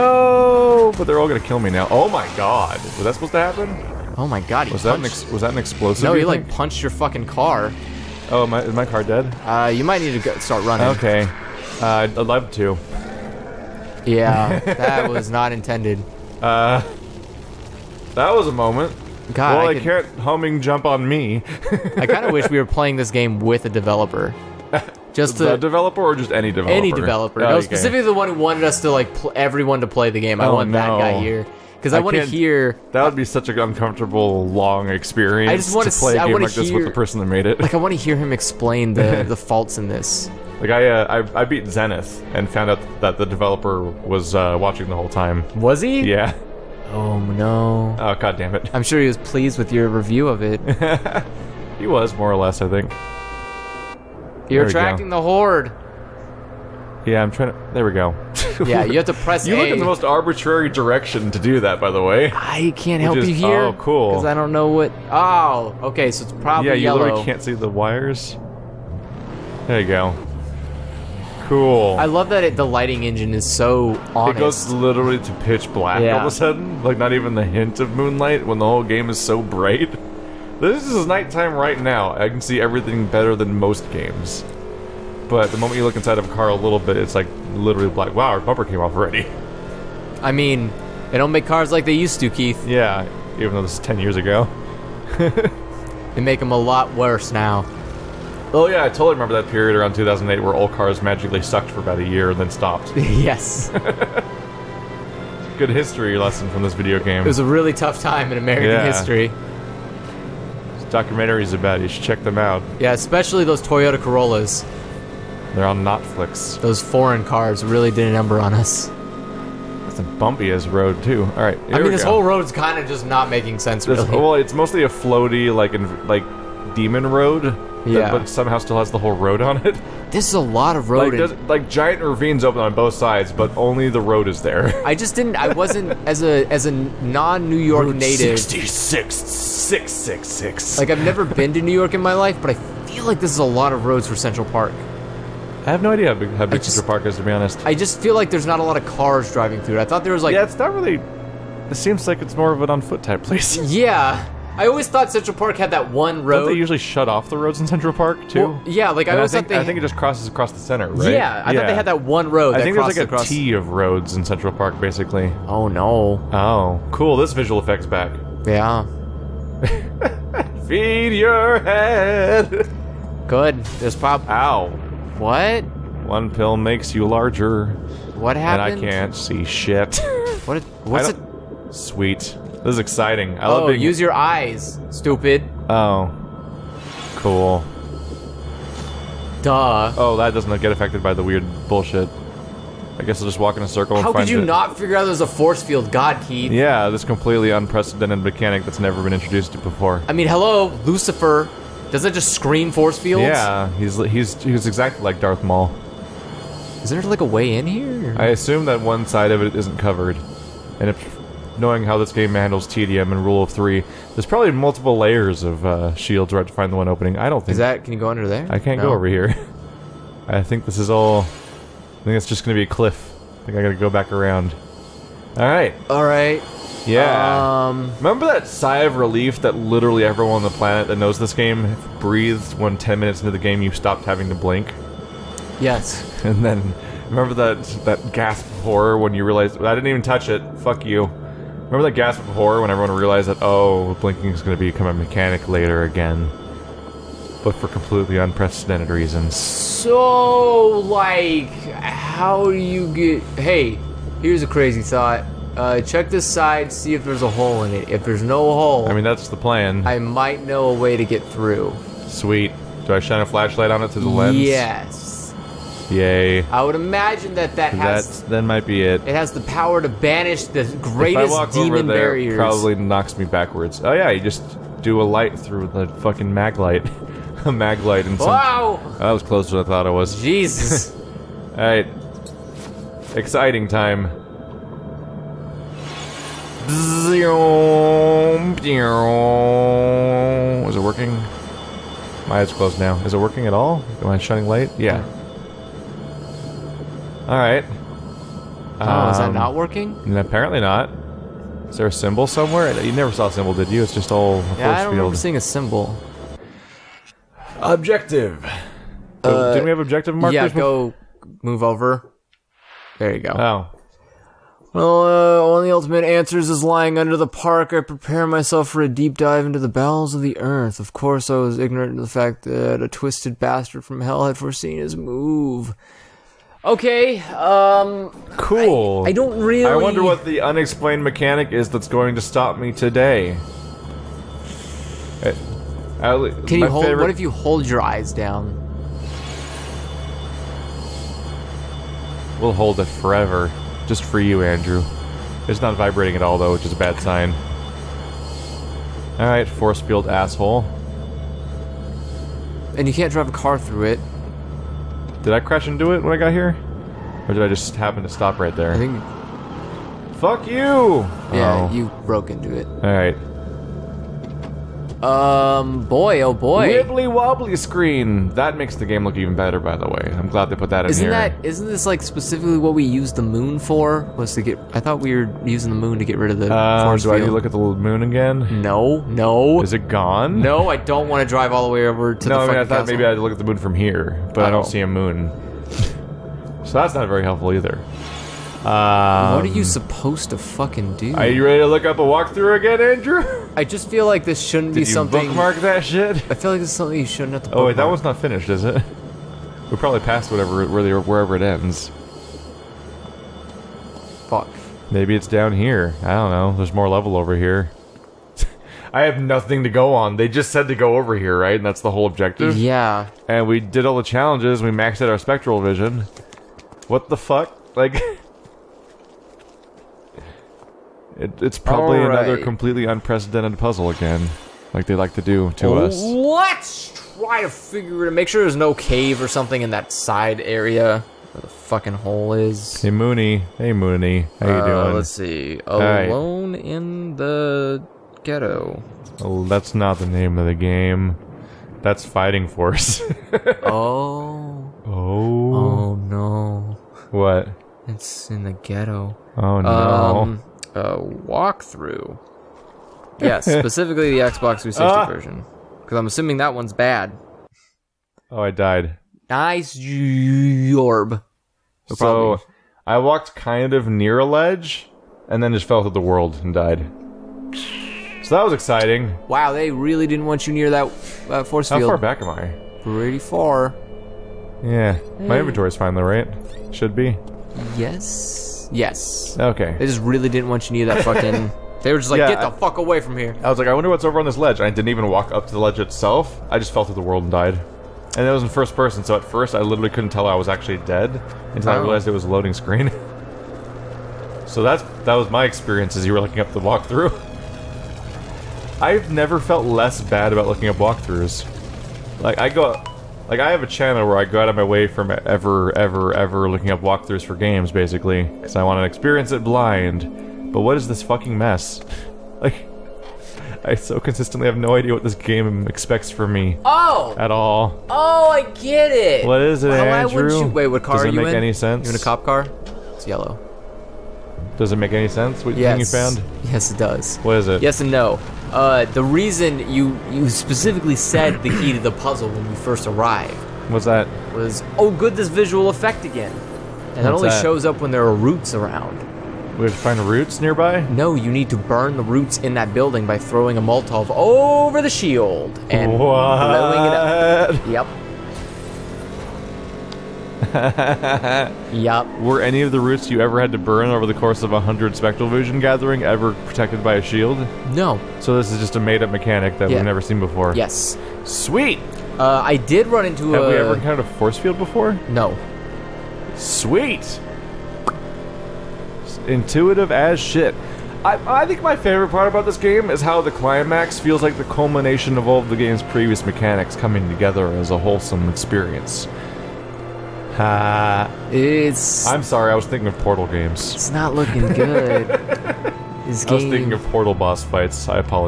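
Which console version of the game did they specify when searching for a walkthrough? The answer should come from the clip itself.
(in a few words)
Xbox 360.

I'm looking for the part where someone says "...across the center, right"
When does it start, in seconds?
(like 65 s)
160 s.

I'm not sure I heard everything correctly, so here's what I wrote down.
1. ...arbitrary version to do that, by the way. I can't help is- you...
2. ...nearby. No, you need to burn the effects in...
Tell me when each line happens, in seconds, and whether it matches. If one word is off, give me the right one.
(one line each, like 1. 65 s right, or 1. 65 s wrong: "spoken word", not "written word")
1. 60 s wrong: "direction", not "version"
2. 540 s wrong: "roots", not "effects".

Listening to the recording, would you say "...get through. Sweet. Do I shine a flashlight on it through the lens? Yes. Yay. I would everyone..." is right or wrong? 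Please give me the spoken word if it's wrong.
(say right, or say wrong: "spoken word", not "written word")
wrong: "imagine", not "everyone".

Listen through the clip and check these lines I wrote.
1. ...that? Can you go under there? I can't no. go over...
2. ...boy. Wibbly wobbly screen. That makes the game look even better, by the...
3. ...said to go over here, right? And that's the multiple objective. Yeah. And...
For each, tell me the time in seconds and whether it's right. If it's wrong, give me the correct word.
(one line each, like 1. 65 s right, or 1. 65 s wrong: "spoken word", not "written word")
1. 217 s right
2. 366 s right
3. 410 s wrong: "whole", not "multiple".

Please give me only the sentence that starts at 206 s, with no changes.
Is there like a way in here?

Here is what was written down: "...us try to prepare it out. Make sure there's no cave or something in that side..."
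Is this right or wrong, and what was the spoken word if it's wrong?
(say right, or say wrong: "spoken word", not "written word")
wrong: "figure", not "prepare".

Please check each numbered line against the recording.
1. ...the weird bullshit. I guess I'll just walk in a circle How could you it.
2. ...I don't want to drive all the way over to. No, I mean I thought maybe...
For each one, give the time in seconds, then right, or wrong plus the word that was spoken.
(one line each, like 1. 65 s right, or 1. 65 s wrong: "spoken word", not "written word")
1. 191 s right
2. 380 s right.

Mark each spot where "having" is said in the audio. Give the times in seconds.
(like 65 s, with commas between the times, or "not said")
234 s.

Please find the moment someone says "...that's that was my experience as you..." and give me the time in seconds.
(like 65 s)
494 s.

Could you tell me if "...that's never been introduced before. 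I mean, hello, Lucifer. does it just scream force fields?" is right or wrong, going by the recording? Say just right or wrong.
right.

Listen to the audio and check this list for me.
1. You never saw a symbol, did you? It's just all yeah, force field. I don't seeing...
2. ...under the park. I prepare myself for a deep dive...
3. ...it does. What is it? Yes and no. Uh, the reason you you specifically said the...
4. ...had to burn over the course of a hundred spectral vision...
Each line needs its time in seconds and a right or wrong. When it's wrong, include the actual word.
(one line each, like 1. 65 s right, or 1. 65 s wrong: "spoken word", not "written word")
1. 302 s right
2. 316 s right
3. 526 s right
4. 553 s right.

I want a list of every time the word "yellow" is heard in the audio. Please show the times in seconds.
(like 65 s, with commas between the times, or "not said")
66 s, 523 s.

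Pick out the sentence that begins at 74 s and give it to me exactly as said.
it goes literally to pitch black all of a sudden.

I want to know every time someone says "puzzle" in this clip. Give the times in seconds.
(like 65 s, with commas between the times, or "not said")
423 s, 531 s.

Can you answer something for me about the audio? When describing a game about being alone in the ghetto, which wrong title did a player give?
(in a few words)
Fighting Force.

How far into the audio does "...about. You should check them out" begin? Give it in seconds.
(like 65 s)
111 s.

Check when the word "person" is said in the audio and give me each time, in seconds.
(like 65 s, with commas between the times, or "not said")
36 s, 488 s.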